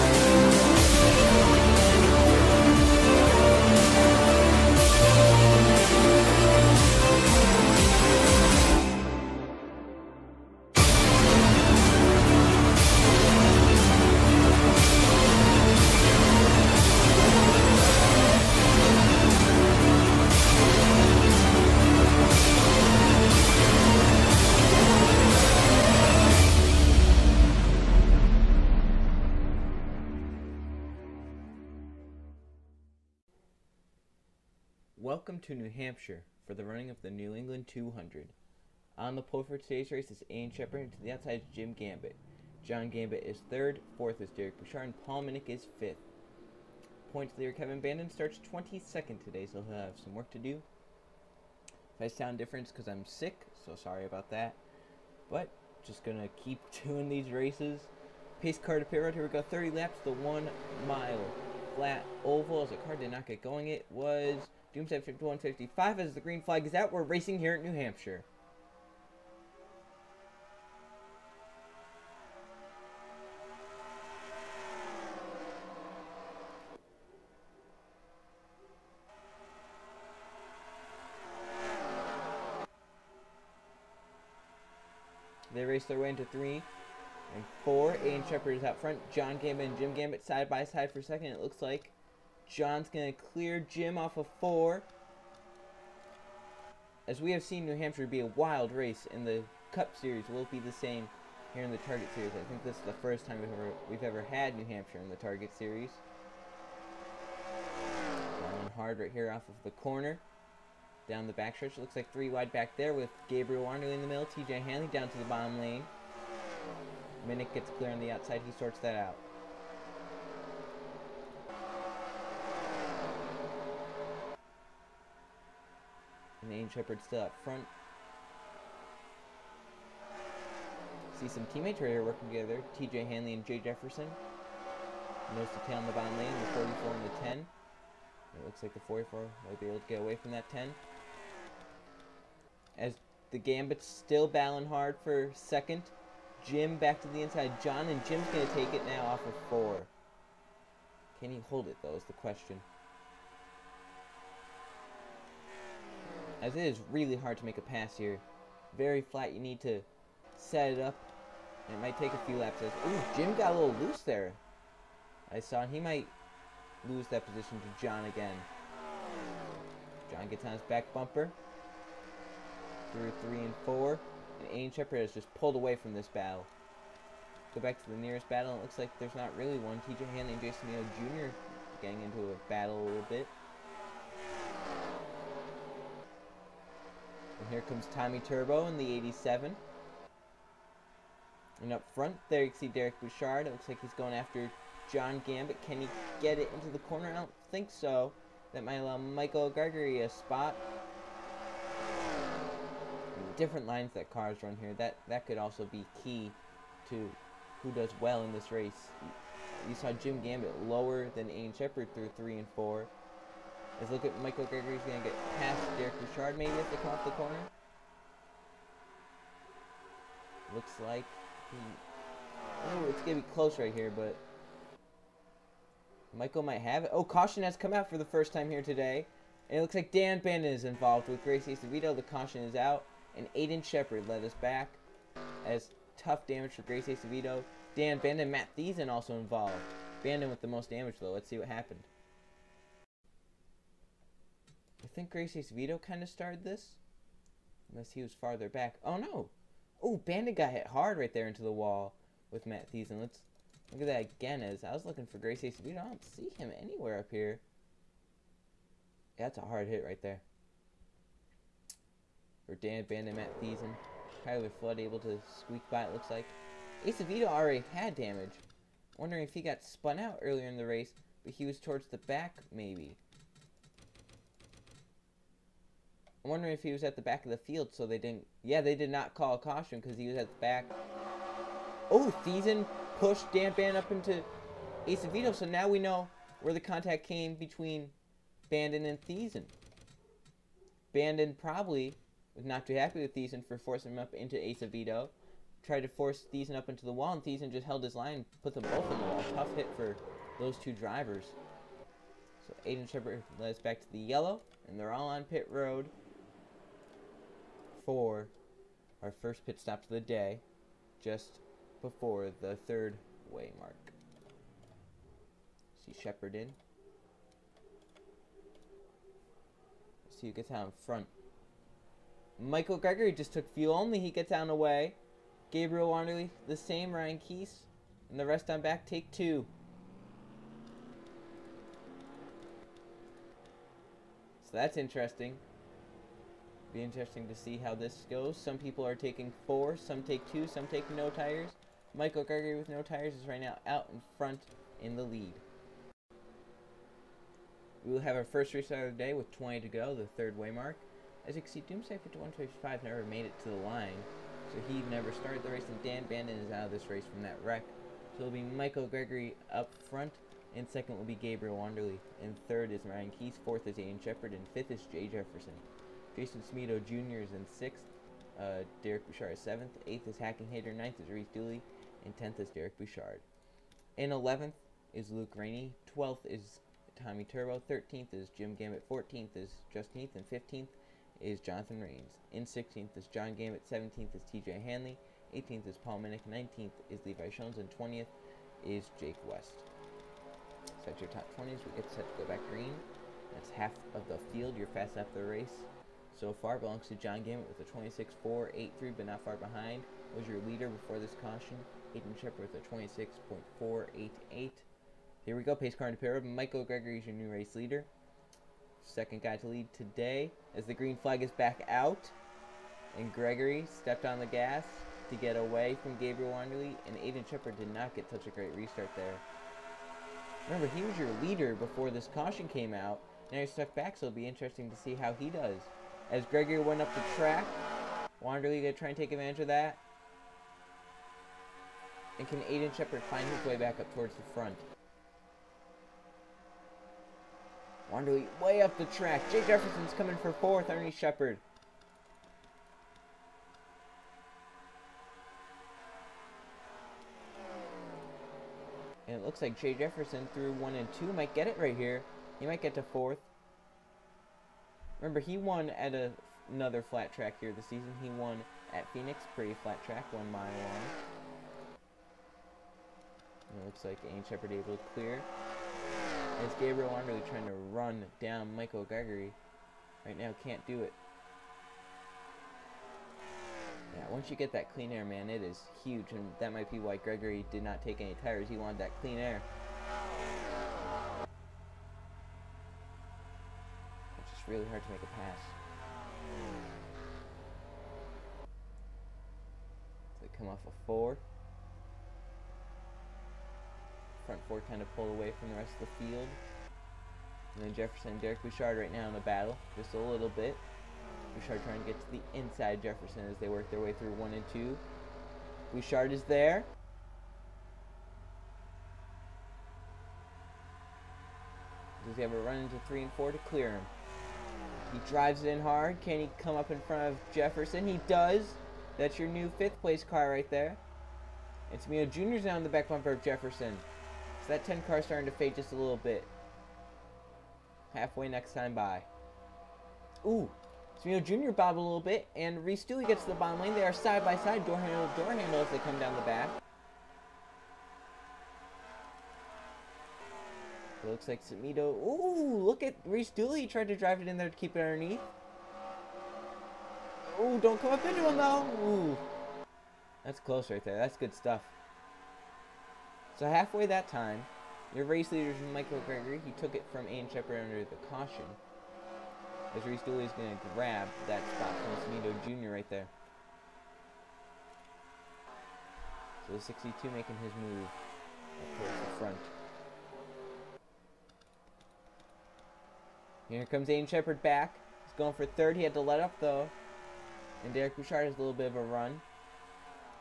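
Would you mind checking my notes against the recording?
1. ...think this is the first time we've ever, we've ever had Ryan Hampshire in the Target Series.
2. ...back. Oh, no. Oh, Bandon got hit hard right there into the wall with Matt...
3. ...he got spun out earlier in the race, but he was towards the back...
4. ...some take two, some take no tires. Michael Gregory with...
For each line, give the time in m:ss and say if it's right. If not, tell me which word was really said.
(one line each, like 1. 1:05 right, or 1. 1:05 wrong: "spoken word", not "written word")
1. 1:42 wrong: "New", not "Ryan"
2. 4:08 right
3. 4:29 right
4. 5:39 right.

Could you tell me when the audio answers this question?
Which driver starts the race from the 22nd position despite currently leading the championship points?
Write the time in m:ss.
0:47.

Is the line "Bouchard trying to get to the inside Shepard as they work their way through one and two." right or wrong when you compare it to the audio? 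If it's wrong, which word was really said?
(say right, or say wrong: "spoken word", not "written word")
wrong: "Jefferson", not "Shepard".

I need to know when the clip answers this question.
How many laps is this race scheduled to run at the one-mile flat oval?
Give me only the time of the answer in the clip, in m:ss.
0:59.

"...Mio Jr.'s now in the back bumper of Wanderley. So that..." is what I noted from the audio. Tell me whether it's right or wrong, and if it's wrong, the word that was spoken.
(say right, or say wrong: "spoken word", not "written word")
wrong: "Jefferson", not "Wanderley".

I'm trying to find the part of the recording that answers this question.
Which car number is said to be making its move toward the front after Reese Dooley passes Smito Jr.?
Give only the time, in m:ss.
9:26.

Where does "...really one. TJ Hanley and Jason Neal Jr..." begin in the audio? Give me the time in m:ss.
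2:59.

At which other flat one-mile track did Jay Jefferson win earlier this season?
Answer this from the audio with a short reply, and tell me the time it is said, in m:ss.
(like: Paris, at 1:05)
Phoenix, at 7:38.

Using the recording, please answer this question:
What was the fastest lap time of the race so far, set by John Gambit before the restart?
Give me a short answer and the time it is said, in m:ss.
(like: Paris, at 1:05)
26.483, at 6:38.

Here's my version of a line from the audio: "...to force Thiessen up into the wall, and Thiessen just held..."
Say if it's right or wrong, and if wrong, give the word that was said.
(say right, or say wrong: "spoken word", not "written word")
right.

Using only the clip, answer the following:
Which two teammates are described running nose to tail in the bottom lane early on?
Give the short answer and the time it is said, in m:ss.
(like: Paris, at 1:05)
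TJ Hanley and Jay Jefferson, at 2:12.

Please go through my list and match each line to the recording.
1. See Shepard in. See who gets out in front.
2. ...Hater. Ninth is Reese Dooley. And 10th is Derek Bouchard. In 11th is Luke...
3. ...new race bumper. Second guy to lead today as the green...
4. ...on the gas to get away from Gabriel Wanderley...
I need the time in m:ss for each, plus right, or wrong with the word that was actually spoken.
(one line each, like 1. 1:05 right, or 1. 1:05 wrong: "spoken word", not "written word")
1. 5:15 right
2. 6:10 right
3. 6:47 wrong: "leader", not "bumper"
4. 6:54 right.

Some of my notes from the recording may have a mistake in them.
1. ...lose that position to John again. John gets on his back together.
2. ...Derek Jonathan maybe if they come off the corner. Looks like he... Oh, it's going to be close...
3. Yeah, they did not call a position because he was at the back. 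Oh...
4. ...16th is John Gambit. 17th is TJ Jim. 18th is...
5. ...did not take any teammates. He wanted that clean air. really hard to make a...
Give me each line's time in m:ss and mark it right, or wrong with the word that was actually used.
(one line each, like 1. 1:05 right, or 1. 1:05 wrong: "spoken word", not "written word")
1. 2:46 wrong: "bumper", not "together"
2. 3:35 wrong: "Richard", not "Jonathan"
3. 4:38 wrong: "caution", not "position"
4. 6:22 wrong: "Hanley", not "Jim"
5. 7:57 wrong: "tires", not "teammates".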